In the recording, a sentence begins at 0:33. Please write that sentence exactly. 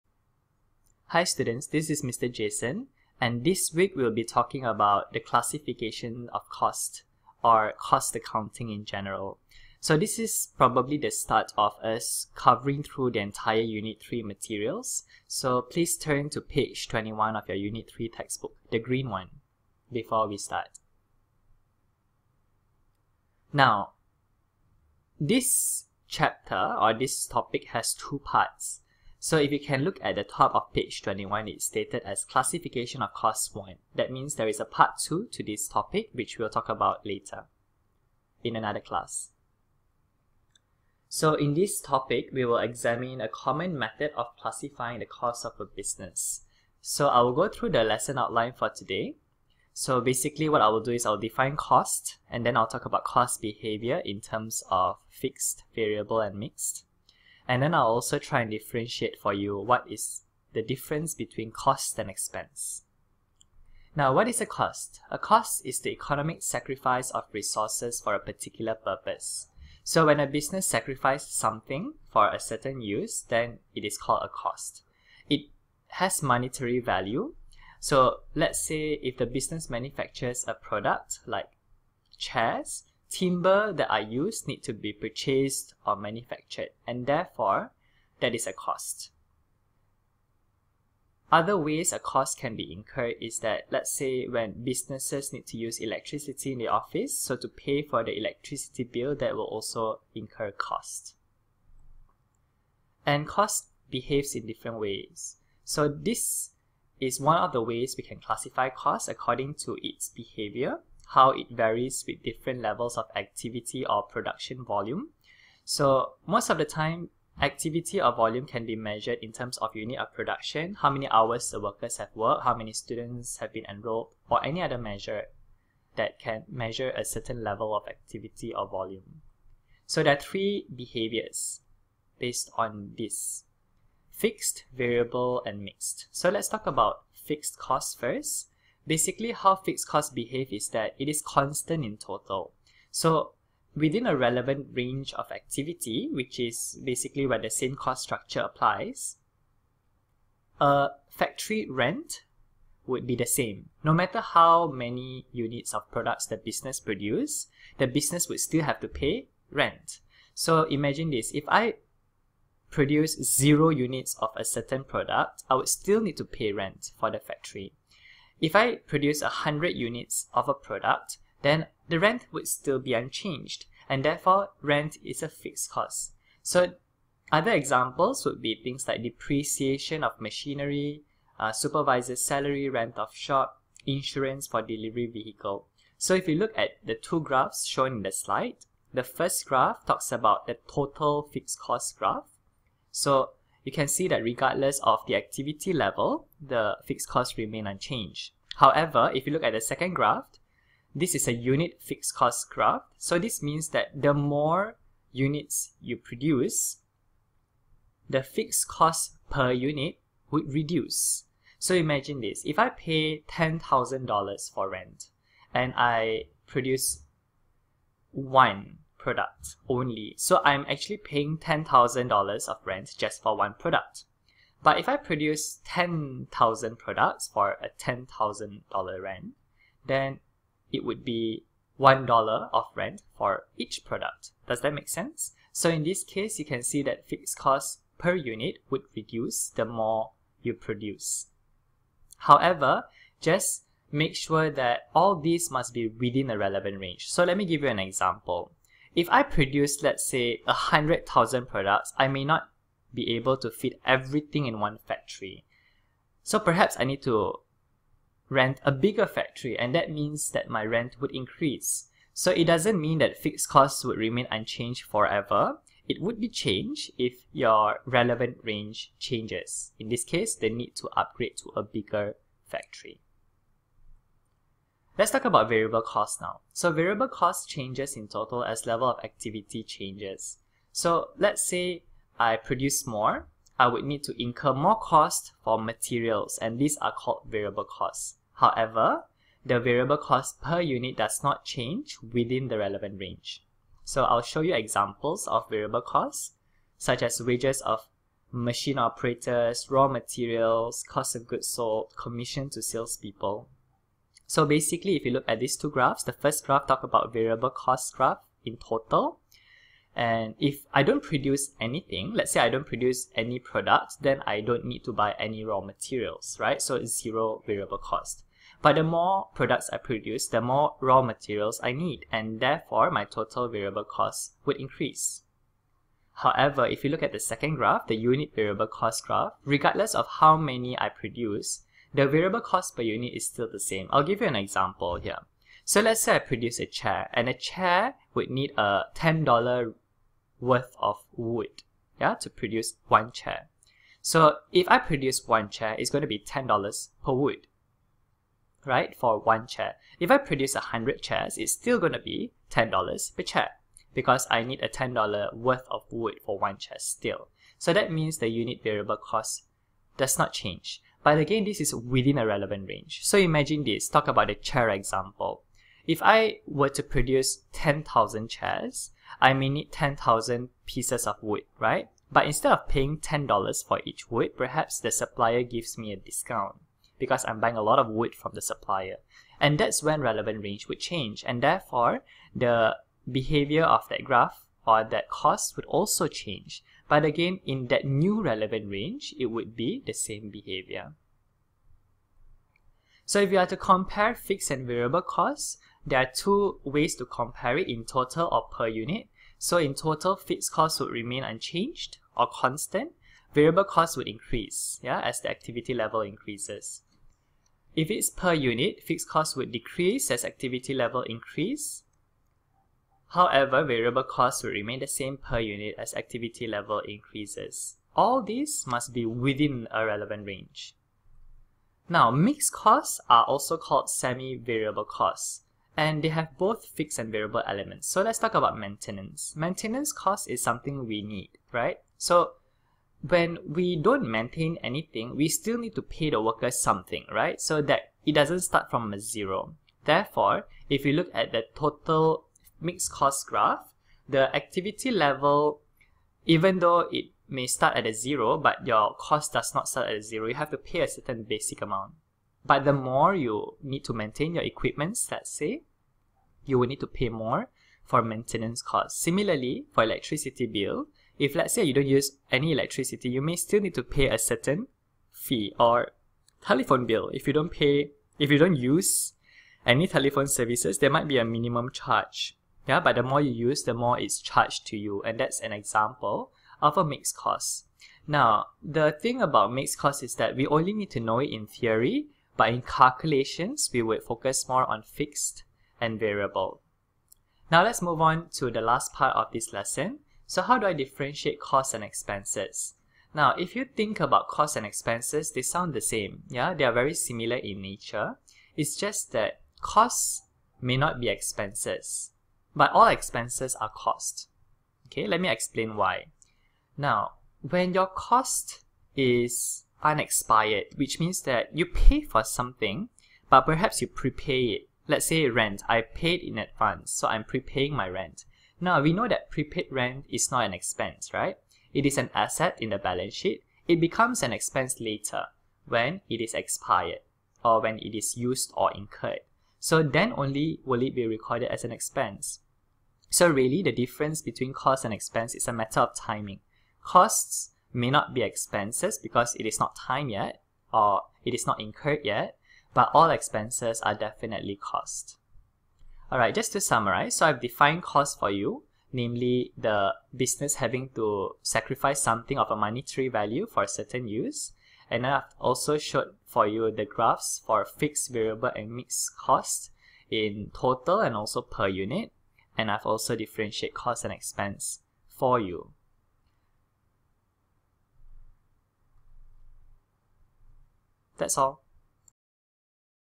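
That means there is a part 2 to this topic which we'll talk about later in another class.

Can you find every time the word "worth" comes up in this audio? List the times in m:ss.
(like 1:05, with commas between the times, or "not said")
5:40, 5:55.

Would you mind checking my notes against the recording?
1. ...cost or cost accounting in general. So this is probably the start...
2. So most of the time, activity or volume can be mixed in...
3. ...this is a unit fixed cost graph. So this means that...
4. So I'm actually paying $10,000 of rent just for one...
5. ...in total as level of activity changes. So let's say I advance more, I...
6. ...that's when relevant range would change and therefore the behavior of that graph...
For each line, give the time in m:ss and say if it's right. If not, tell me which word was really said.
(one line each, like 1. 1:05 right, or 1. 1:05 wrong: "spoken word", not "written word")
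1. 0:06 right
2. 1:55 wrong: "measured", not "mixed"
3. 3:20 right
4. 3:40 right
5. 4:37 wrong: "produce", not "advance"
6. 6:19 right.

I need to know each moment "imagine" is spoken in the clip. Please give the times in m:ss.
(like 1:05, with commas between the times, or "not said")
2:40, 3:31, 6:03.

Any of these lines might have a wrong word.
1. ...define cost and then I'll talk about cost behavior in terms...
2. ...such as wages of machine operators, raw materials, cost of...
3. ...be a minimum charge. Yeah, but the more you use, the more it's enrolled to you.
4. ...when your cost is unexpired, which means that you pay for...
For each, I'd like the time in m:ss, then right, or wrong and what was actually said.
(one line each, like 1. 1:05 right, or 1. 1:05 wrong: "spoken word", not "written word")
1. 0:51 right
2. 4:56 right
3. 7:51 wrong: "charged", not "enrolled"
4. 8:27 right.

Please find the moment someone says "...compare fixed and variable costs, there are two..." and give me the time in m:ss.
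6:33.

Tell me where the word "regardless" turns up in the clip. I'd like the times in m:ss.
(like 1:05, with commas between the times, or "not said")
3:14, 5:29.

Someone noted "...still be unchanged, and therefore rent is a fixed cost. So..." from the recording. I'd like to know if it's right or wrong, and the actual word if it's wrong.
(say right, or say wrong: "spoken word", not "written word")
right.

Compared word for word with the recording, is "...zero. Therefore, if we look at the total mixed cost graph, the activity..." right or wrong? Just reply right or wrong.
right.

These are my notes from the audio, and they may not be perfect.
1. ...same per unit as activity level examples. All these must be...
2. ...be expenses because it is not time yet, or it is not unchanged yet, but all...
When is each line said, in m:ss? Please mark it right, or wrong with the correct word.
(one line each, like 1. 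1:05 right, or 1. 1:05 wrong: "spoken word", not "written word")
1. 6:54 wrong: "increases", not "examples"
2. 8:58 wrong: "incurred", not "unchanged".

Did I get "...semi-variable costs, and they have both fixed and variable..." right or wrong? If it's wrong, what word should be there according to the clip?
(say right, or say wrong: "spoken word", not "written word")
right.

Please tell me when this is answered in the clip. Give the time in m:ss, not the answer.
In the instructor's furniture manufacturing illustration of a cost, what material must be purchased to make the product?
1:23.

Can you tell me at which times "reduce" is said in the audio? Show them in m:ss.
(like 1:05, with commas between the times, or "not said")
3:30, 3:58.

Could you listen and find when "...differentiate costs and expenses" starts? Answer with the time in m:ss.
8:10.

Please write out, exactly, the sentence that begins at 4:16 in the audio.
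So perhaps I need to rent a bigger factory and that means that my rent would increase.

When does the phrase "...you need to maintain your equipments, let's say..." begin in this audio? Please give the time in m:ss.
7:33.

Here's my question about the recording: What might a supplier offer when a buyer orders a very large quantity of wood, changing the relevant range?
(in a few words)
a discount.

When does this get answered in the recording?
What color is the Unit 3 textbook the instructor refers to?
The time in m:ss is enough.
0:18.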